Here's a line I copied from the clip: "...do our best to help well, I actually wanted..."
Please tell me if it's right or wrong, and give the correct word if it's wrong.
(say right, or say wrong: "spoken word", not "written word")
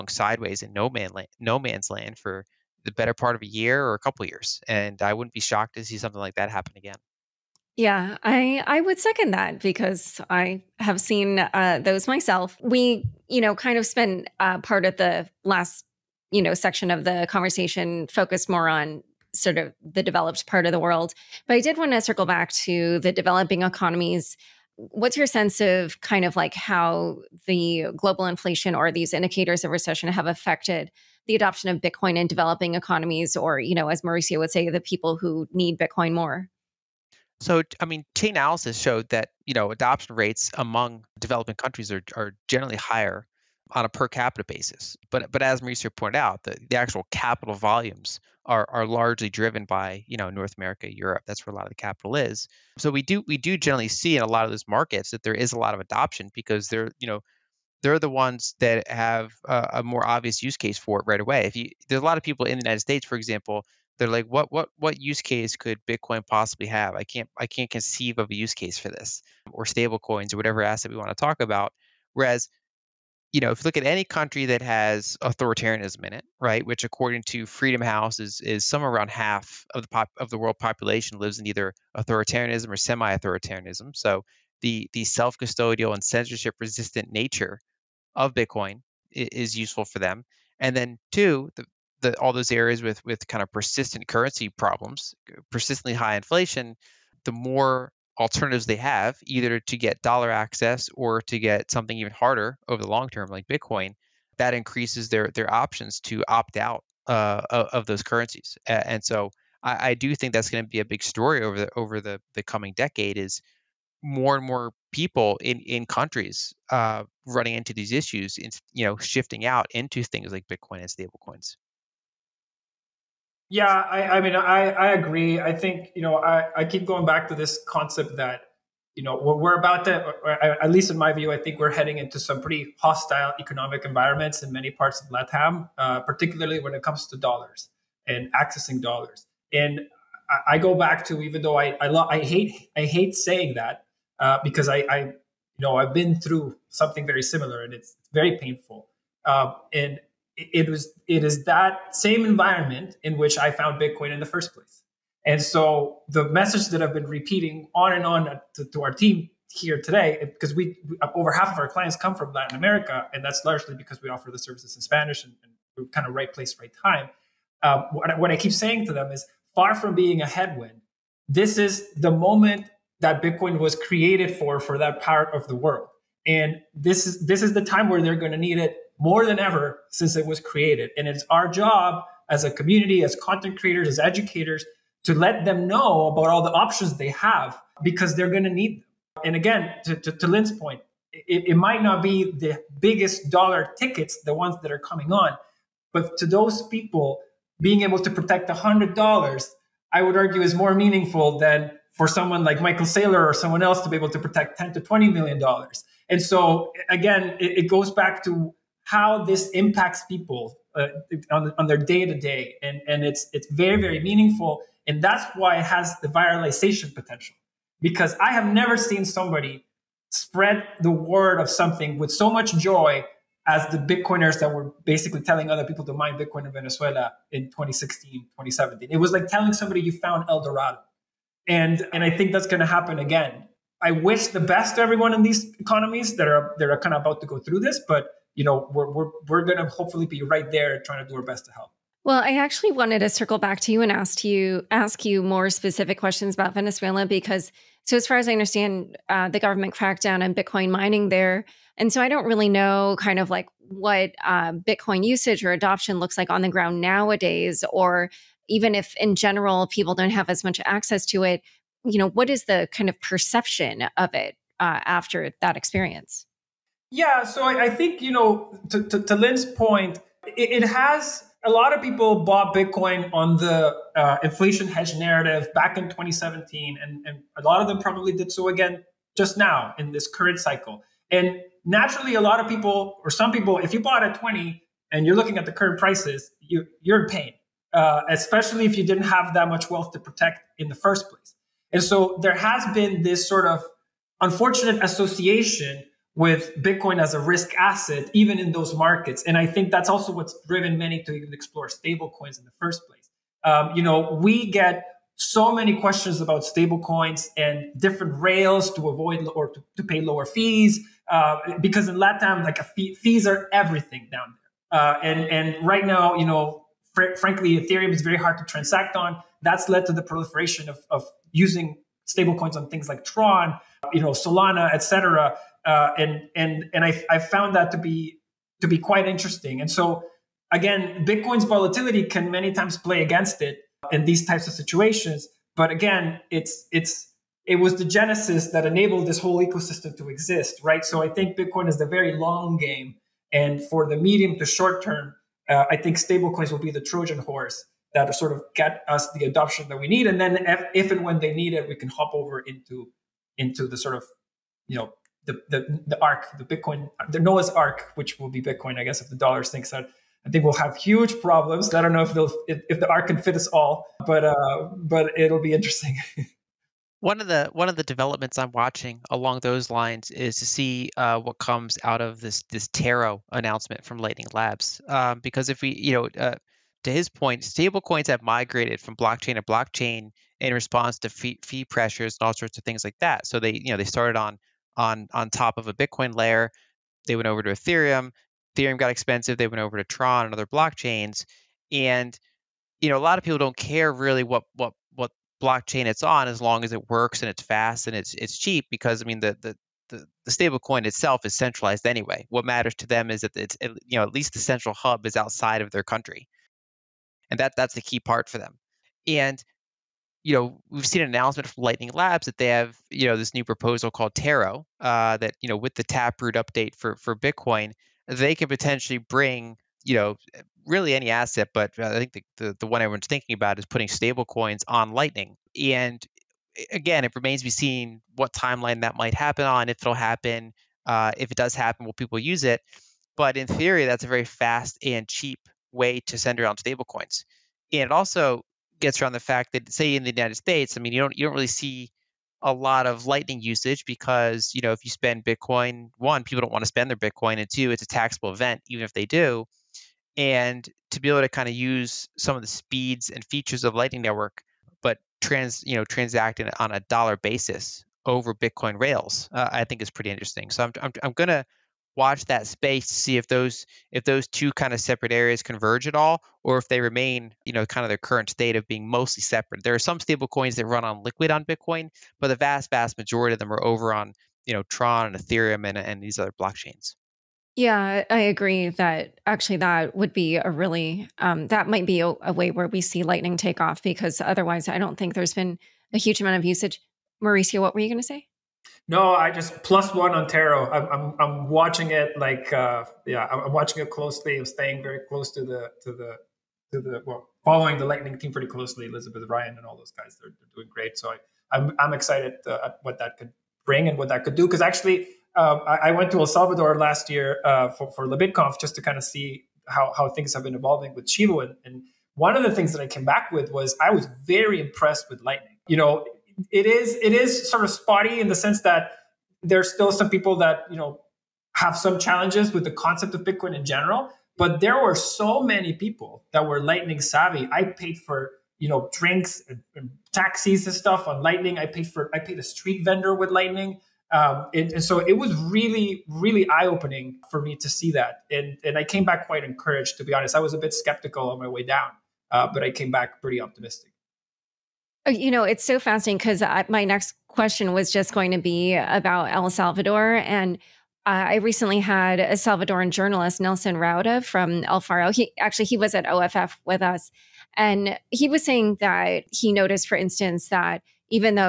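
right.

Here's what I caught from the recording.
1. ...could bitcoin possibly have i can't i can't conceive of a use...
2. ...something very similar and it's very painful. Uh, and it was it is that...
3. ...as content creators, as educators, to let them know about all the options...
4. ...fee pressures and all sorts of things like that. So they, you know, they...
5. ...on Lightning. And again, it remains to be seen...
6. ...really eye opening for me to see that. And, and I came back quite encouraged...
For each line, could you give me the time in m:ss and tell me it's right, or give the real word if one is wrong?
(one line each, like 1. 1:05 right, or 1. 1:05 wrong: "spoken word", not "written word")
1. 1:05 right
2. 2:26 right
3. 3:03 right
4. 6:21 right
5. 7:04 right
6. 8:56 right.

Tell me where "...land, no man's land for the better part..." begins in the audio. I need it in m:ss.
0:01.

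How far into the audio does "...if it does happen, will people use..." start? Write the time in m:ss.
7:11.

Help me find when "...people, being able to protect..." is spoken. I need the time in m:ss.
3:16.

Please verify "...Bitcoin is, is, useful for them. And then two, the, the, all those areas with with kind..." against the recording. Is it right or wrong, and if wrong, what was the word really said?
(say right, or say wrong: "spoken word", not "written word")
right.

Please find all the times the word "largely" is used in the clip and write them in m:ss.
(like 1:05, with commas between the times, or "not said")
0:48, 2:43.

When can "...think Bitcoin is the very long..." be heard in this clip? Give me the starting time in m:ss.
5:41.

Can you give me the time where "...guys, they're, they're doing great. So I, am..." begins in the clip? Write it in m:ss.
8:19.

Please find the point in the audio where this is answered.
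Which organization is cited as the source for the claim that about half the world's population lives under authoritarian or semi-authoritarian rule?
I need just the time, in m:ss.
1:17.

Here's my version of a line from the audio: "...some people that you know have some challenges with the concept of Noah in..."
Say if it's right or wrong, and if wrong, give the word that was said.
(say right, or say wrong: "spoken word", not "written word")
wrong: "Bitcoin", not "Noah".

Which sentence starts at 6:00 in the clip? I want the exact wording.
I think we'll have huge problems.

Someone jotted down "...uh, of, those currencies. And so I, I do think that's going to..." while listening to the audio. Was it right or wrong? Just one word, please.
right.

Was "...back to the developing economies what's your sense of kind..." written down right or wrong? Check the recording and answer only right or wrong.
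right.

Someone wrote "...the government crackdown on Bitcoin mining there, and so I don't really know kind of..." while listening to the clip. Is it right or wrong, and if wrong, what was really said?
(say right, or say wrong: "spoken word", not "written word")
right.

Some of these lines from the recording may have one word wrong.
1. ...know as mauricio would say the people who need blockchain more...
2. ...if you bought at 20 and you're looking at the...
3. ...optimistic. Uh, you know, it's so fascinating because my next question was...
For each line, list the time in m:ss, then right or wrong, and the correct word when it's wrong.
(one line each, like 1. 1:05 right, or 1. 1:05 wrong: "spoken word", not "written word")
1. 0:33 wrong: "bitcoin", not "blockchain"
2. 4:43 right
3. 9:03 right.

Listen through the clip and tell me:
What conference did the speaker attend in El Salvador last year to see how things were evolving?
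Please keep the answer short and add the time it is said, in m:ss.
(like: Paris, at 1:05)
LaBitConf, at 8:28.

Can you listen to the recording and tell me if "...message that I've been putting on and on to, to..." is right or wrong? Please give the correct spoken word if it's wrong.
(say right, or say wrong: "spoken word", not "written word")
wrong: "repeating", not "putting".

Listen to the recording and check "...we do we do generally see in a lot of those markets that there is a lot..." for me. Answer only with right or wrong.
right.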